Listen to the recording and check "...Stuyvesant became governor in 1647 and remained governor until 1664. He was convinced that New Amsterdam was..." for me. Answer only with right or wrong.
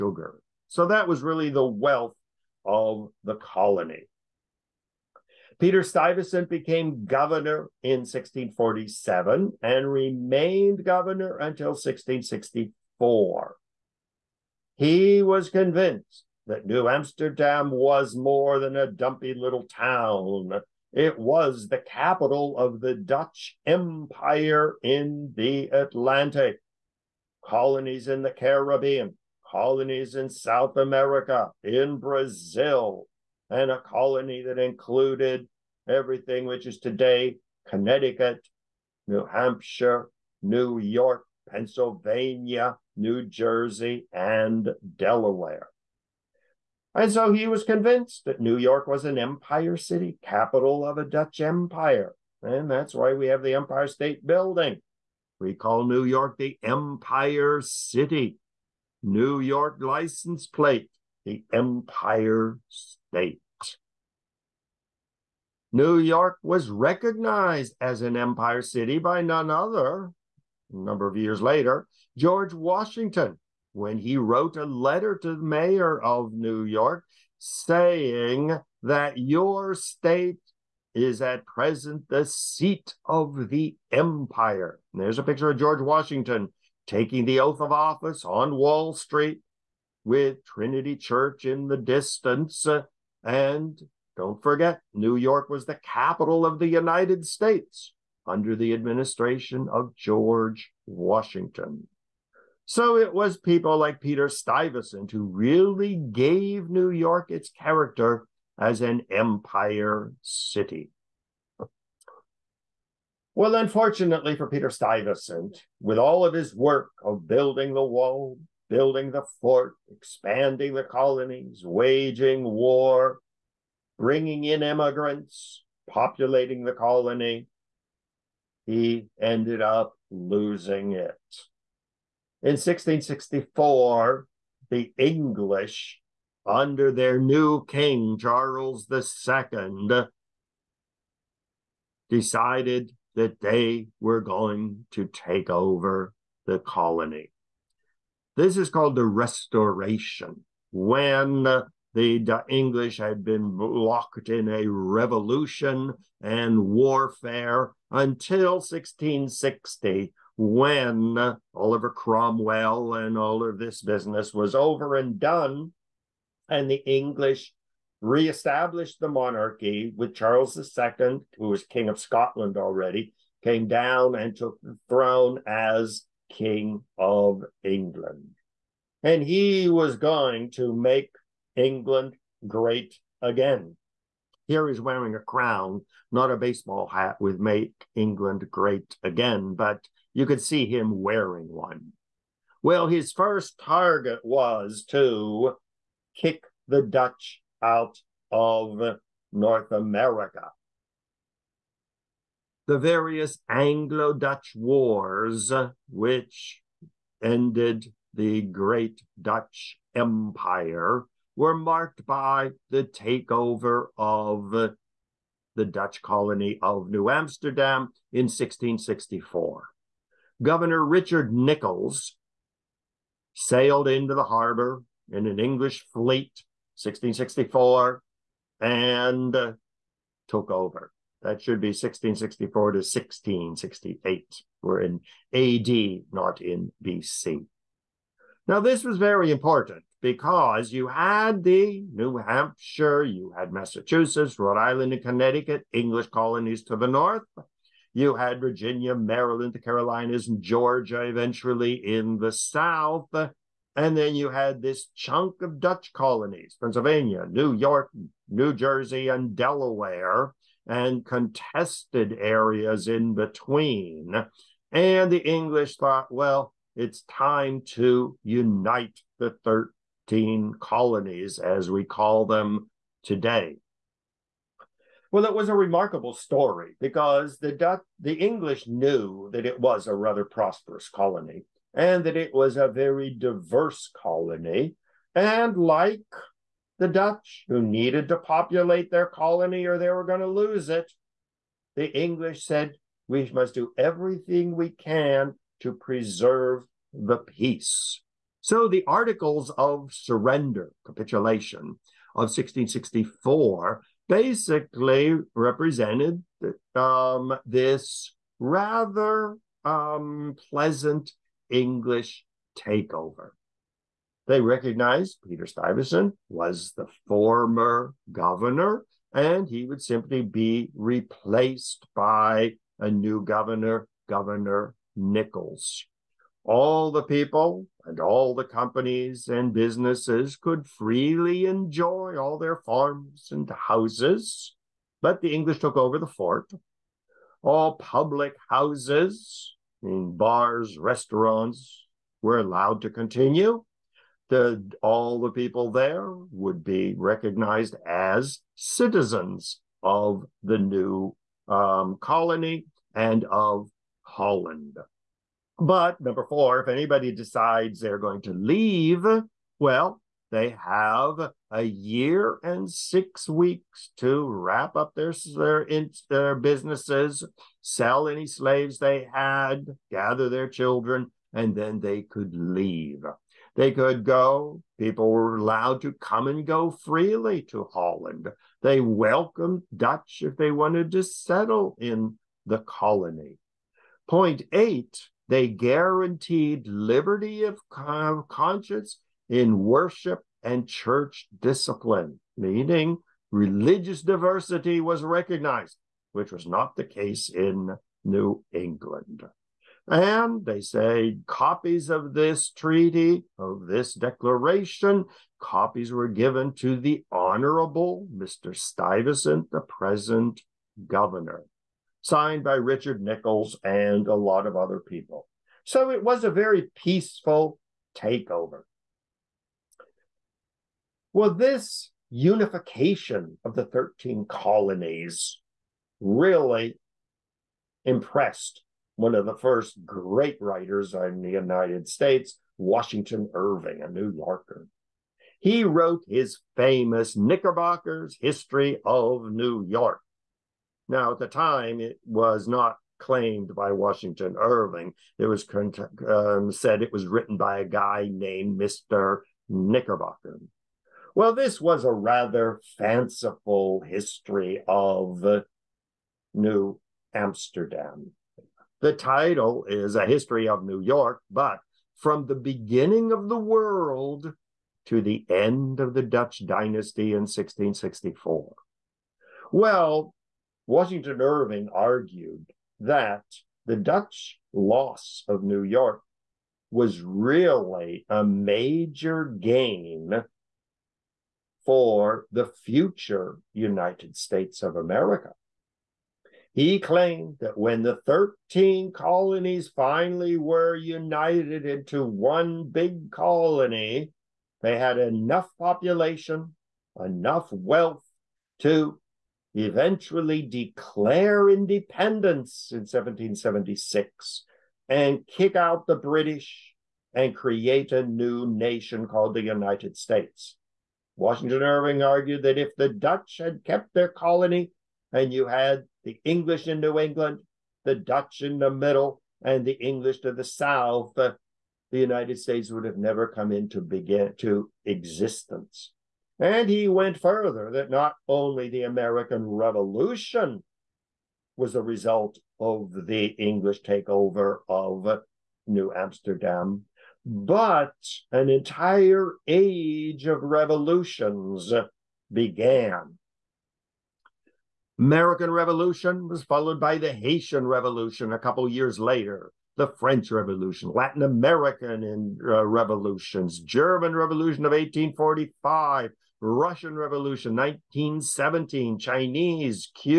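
right.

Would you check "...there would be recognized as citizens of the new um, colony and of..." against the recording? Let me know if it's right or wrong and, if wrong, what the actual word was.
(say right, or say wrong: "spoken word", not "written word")
right.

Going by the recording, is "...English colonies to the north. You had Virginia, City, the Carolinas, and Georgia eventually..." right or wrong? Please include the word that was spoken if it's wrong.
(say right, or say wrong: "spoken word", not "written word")
wrong: "Maryland", not "City".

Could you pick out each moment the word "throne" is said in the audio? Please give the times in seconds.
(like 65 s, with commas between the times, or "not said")
174 s.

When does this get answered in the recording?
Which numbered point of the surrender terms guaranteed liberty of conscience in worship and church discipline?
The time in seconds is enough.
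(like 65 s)
384 s.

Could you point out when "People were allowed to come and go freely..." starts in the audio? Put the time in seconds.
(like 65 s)
374 s.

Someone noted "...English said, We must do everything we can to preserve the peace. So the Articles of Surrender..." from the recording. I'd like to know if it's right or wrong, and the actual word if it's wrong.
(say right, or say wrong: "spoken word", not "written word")
right.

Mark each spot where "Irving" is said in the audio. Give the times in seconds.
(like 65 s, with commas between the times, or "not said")
433 s, 444 s, 471 s, 511 s.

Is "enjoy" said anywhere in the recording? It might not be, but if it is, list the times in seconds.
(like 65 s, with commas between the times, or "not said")
331 s.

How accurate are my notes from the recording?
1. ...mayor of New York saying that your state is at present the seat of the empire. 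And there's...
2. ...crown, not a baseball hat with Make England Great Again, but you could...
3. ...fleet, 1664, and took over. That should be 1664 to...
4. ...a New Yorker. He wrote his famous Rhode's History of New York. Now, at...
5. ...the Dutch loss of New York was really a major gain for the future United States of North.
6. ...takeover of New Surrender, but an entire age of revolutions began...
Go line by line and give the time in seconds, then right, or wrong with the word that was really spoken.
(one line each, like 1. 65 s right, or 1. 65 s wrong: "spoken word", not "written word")
1. 75 s right
2. 185 s right
3. 225 s right
4. 433 s wrong: "Knickerbocker", not "Rhode"
5. 473 s wrong: "America", not "North"
6. 533 s wrong: "Amsterdam", not "Surrender".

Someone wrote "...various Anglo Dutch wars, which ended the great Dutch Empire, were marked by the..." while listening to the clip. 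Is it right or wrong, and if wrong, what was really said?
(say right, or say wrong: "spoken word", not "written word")
right.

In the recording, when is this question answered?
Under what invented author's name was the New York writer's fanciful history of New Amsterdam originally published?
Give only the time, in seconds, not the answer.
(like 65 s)
448 s.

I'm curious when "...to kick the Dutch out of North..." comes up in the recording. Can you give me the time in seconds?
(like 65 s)
194 s.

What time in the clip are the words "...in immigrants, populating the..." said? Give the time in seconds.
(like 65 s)
124 s.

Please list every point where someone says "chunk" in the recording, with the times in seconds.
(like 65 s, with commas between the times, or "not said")
254 s.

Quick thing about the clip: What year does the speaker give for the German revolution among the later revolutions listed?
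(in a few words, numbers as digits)
1845.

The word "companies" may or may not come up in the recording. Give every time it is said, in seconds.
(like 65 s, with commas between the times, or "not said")
328 s.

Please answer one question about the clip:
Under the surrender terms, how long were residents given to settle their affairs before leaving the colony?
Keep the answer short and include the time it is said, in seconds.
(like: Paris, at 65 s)
A year and six weeks, at 361 s.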